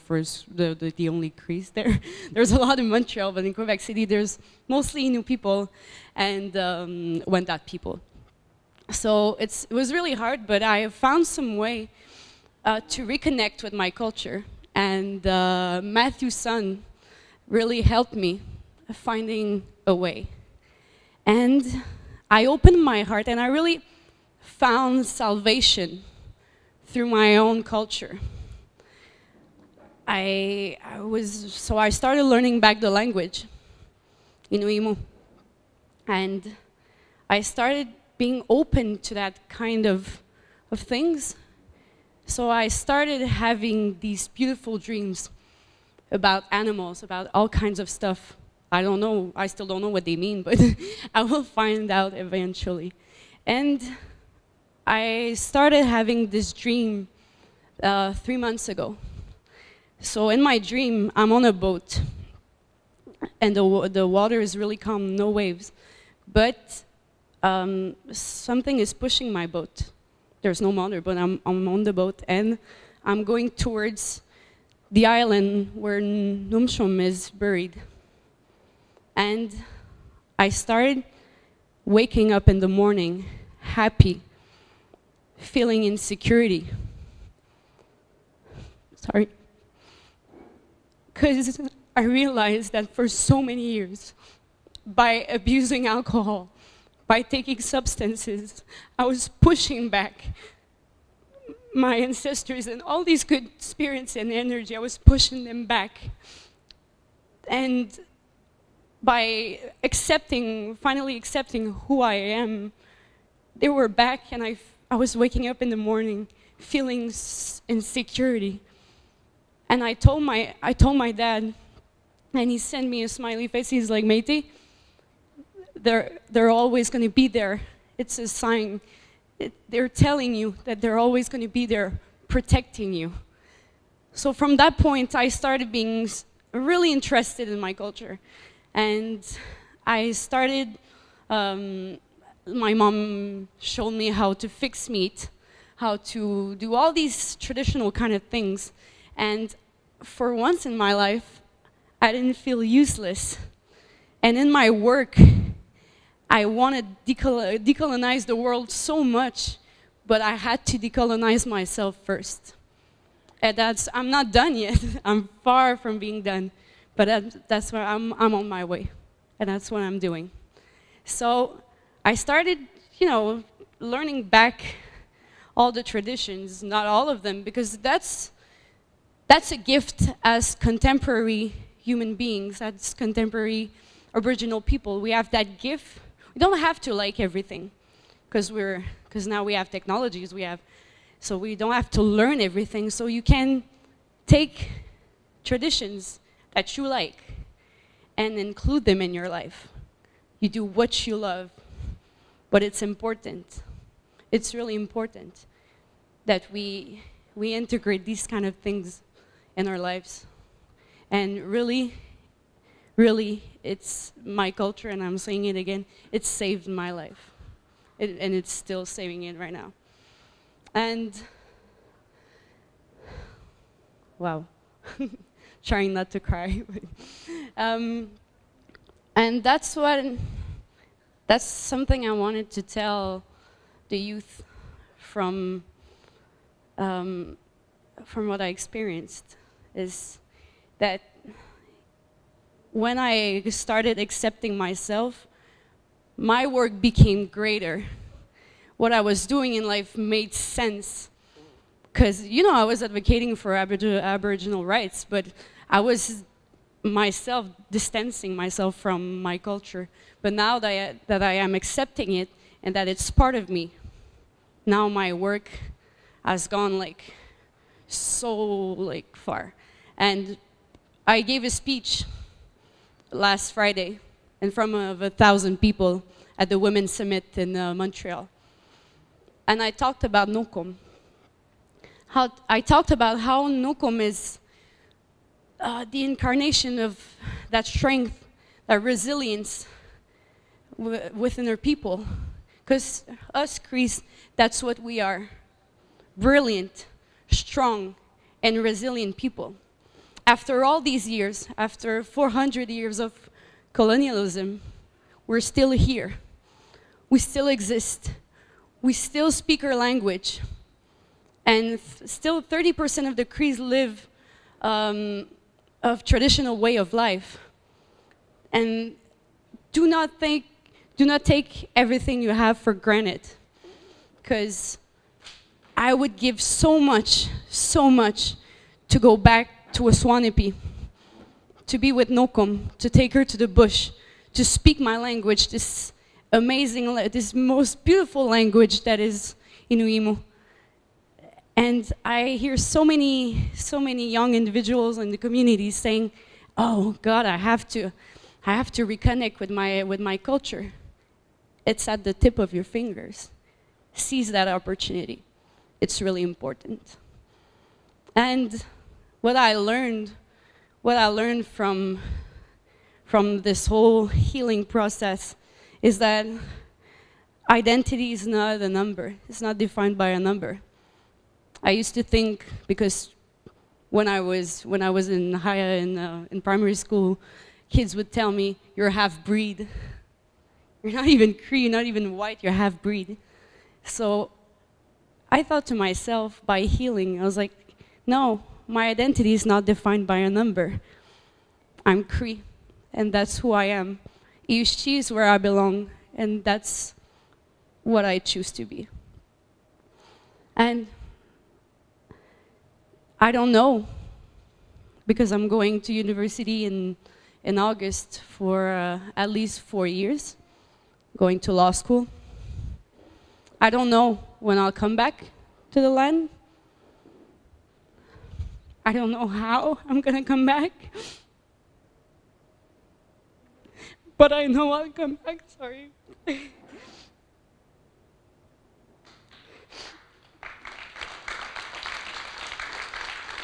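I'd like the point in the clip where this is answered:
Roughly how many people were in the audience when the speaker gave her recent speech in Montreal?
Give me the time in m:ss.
4:35.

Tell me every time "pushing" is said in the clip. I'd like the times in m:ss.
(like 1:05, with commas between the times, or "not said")
1:08, 1:39, 1:44.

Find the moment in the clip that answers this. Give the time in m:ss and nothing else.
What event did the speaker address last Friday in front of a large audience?
4:36.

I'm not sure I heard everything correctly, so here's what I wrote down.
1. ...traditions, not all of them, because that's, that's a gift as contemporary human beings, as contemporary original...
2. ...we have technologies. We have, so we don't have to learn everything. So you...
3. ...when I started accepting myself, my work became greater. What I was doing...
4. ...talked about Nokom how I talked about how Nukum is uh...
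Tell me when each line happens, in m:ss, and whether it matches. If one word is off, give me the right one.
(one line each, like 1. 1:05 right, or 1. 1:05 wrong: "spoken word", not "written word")
1. 2:55 right
2. 3:09 right
3. 4:02 right
4. 4:39 right.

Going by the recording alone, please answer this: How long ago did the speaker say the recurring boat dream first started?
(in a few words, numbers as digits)
3 months ago.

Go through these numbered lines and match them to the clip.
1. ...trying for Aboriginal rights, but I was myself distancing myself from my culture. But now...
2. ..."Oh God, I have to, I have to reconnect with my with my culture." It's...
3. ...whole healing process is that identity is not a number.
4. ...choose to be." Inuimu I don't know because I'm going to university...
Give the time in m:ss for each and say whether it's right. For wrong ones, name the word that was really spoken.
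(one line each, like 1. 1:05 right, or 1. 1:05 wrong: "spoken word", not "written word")
1. 4:12 wrong: "advocating", not "trying"
2. 5:46 right
3. 6:03 right
4. 6:38 wrong: "And", not "Inuimu".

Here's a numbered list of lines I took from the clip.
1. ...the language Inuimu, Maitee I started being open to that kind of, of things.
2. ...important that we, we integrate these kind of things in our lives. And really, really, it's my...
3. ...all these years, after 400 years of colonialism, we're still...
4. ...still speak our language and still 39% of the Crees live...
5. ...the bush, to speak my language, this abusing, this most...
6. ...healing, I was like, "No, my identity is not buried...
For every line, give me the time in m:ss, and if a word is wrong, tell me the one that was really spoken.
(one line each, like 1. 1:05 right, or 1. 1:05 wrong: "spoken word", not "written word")
1. 0:32 wrong: "And", not "Maitee"
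2. 3:24 right
3. 5:00 right
4. 5:08 wrong: "30", not "39"
5. 5:33 wrong: "amazing", not "abusing"
6. 6:26 wrong: "defined", not "buried".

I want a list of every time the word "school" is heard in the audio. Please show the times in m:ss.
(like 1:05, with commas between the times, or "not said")
6:16, 6:51.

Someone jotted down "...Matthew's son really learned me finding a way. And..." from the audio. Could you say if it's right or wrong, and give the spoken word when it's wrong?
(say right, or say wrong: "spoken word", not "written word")
wrong: "helped", not "learned".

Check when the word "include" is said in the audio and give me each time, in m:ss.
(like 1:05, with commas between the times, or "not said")
3:18.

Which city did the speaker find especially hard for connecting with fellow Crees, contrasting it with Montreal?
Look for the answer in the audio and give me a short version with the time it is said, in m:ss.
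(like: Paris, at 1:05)
Quebec City, at 0:03.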